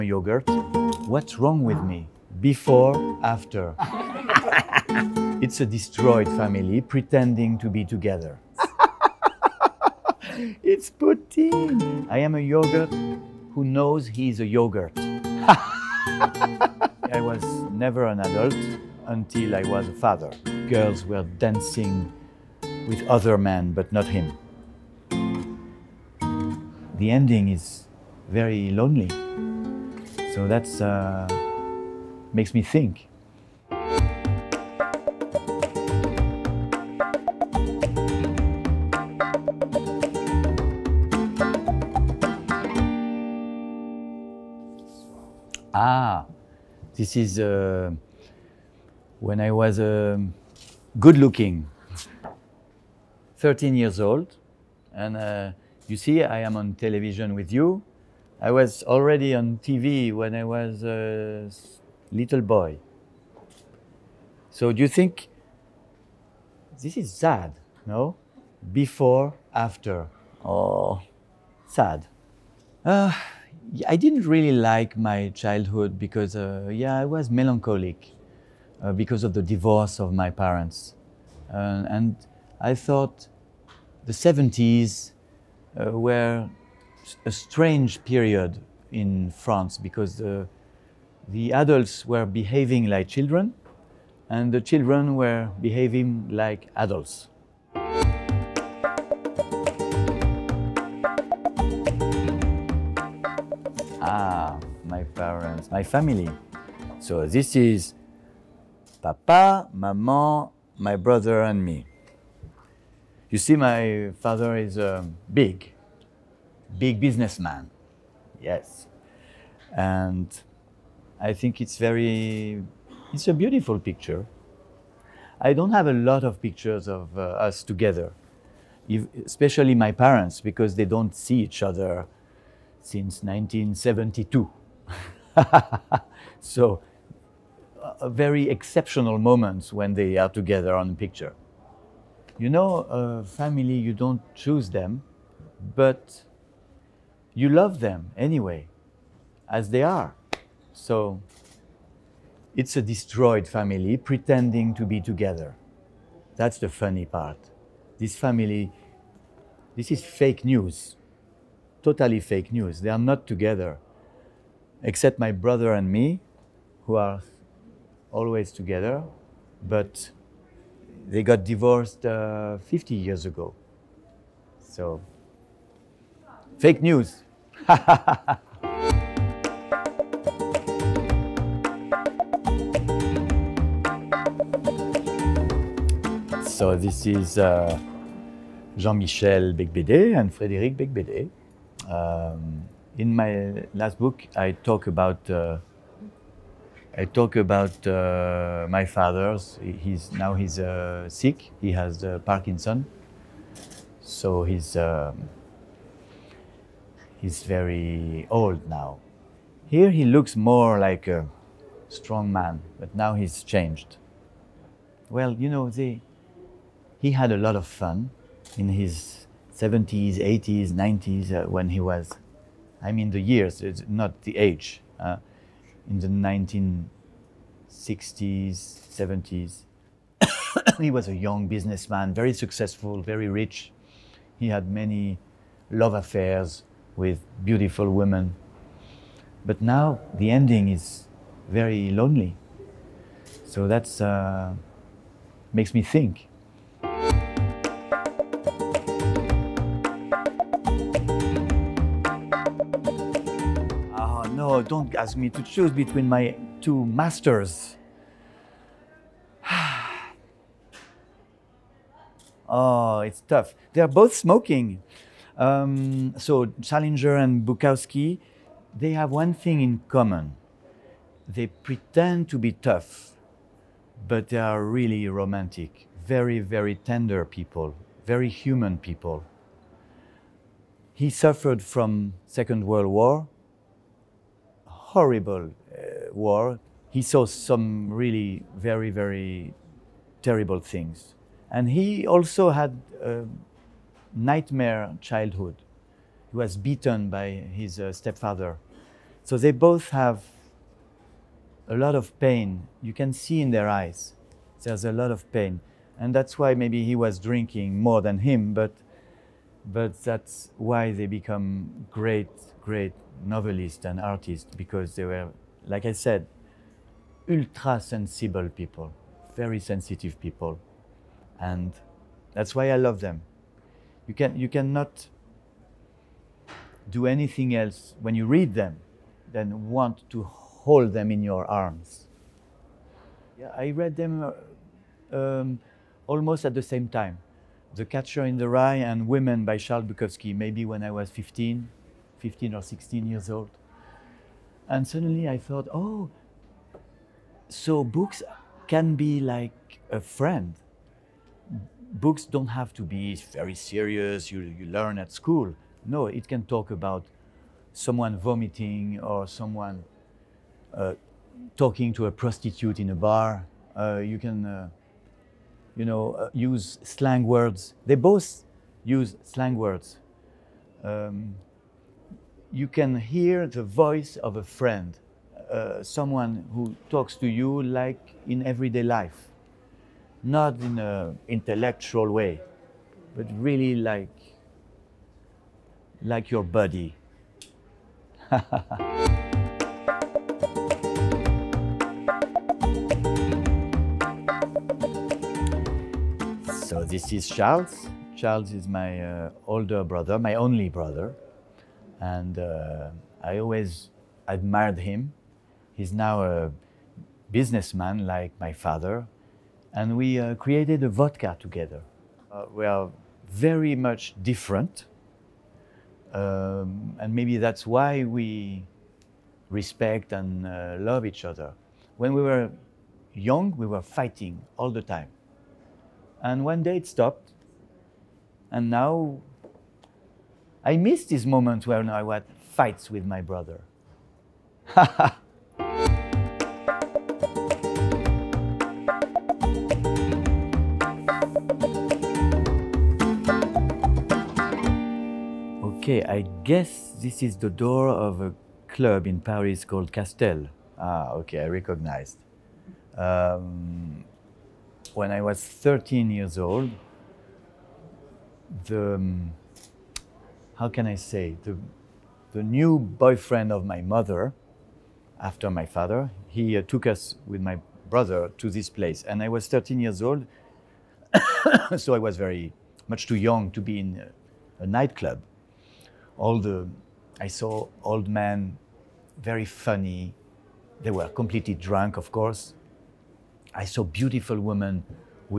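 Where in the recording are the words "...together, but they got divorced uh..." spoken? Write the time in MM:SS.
02:48.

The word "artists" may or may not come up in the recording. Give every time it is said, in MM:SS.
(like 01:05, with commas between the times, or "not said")
05:13.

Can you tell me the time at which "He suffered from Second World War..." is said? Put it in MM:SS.
04:40.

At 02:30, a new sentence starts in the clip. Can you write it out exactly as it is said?
So it's a destroyed family pretending to be together.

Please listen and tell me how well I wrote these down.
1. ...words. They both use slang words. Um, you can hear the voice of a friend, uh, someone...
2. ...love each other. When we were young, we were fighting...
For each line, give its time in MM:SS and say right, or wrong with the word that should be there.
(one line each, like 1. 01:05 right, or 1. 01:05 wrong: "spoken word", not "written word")
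1. 06:07 right
2. 07:00 right.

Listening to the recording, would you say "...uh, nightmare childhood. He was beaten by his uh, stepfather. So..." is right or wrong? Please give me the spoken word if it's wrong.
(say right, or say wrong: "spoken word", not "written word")
right.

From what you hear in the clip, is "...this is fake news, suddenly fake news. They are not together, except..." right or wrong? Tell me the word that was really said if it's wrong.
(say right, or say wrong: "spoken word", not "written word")
wrong: "totally", not "suddenly".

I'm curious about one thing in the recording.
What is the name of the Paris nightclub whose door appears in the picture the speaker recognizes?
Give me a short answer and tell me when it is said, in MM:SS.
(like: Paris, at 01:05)
Castel, at 07:29.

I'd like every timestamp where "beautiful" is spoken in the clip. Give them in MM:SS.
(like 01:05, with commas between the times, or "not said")
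02:03, 03:57, 08:03.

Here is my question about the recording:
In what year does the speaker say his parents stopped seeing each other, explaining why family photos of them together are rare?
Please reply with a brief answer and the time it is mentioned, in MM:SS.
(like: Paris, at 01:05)
1972, at 02:13.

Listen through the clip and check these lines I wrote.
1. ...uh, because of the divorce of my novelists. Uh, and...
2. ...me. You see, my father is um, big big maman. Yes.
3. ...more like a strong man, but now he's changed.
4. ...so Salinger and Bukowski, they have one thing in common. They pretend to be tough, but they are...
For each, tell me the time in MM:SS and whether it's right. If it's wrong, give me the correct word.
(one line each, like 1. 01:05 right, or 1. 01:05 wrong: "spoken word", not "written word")
1. 01:18 wrong: "parents", not "novelists"
2. 01:51 wrong: "businessman", not "maman"
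3. 03:30 right
4. 04:26 right.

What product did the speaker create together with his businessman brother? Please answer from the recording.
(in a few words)
vodka.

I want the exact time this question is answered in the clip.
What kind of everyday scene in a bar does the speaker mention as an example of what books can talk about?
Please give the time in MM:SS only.
06:01.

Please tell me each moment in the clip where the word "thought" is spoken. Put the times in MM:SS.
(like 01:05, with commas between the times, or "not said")
01:22, 05:45.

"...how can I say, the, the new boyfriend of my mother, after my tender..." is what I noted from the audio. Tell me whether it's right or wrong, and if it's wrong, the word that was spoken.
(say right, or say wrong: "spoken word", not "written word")
wrong: "father", not "tender".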